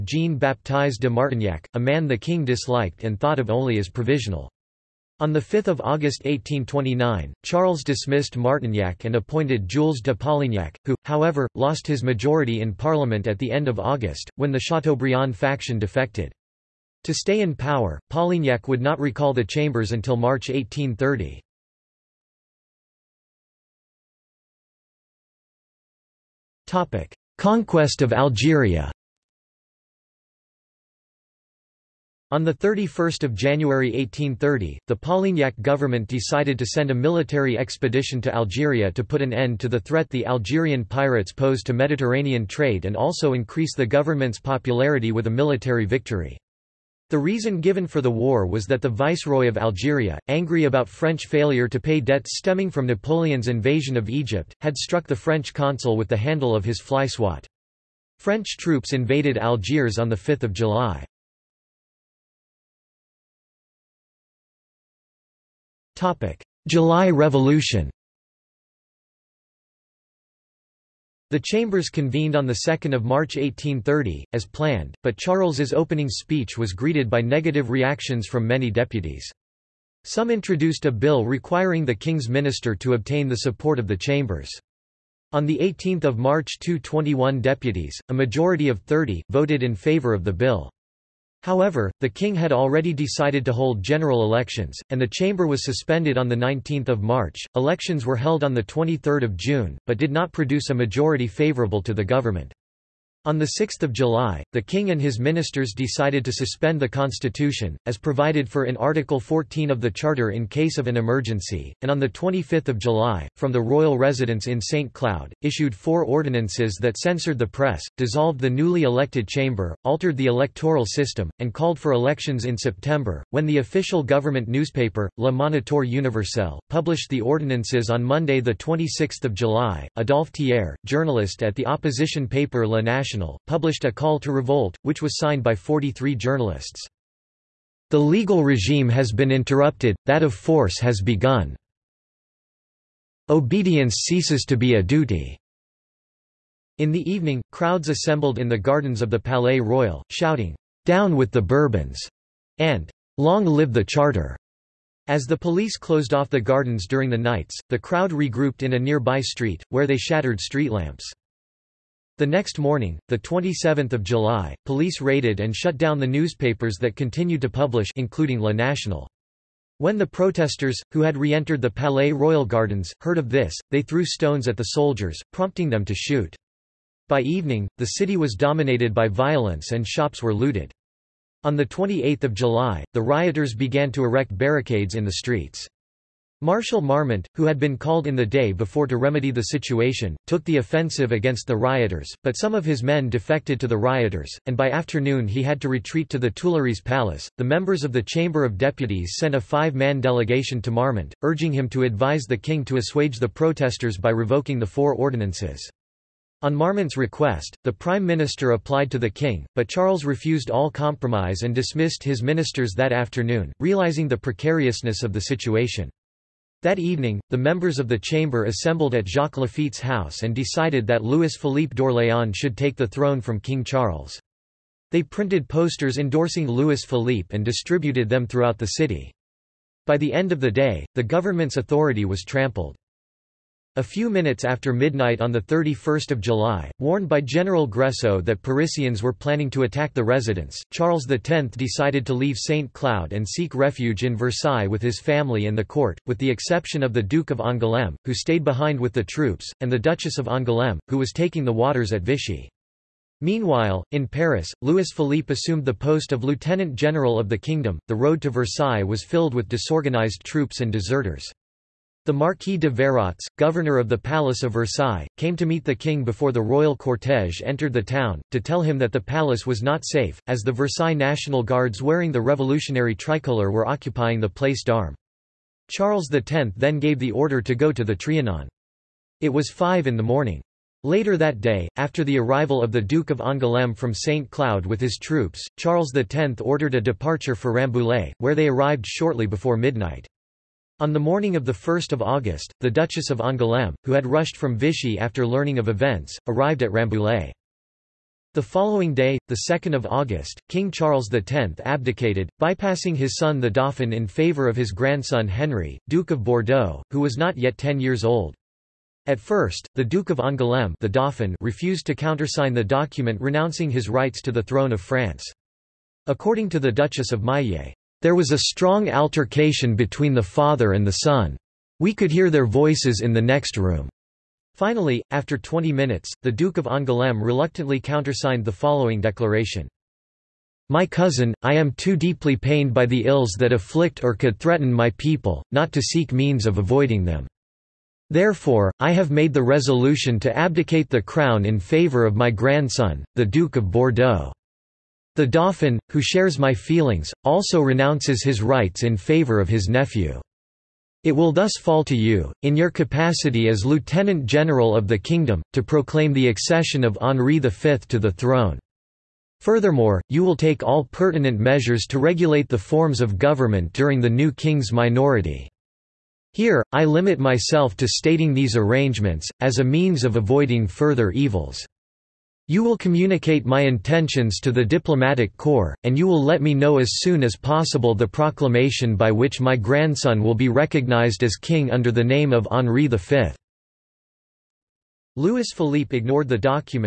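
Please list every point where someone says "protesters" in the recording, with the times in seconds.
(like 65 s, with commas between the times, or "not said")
170 s, 203 s.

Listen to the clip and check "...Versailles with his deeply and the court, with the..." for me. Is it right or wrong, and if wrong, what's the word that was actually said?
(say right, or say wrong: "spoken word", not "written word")
wrong: "family", not "deeply".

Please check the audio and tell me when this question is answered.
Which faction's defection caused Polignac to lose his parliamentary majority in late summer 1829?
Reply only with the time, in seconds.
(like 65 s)
14 s.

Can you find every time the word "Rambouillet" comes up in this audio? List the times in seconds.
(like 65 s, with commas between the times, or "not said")
287 s, 296 s.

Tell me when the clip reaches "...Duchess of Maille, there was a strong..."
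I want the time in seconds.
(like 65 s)
316 s.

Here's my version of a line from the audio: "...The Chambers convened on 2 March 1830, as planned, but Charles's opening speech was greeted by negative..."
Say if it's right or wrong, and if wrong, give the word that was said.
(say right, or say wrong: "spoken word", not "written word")
right.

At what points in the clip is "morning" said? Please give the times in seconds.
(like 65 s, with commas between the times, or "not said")
162 s, 280 s, 290 s.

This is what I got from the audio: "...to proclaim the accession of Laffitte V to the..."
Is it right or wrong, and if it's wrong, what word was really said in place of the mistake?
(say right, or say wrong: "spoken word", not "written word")
wrong: "Henri", not "Laffitte".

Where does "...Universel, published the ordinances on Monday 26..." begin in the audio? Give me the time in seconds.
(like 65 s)
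125 s.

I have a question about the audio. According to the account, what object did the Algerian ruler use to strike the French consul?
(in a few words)
fly swat.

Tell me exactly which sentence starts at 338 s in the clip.
Therefore, I have made the resolution to abdicate the crown in favour of my grandson, the Duke of Bordeaux.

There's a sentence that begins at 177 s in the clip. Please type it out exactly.
By evening, the city was dominated by violence and shops were looted.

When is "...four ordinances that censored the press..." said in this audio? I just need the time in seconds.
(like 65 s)
115 s.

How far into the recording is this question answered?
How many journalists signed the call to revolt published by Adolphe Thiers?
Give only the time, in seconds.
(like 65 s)
135 s.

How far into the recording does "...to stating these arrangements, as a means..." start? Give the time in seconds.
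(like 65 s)
367 s.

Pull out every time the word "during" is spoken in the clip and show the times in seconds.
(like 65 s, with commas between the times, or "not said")
156 s, 363 s.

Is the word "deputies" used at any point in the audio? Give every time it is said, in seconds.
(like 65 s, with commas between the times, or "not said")
78 s, 87 s, 198 s.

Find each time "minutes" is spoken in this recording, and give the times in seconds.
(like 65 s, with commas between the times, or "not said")
234 s, 325 s.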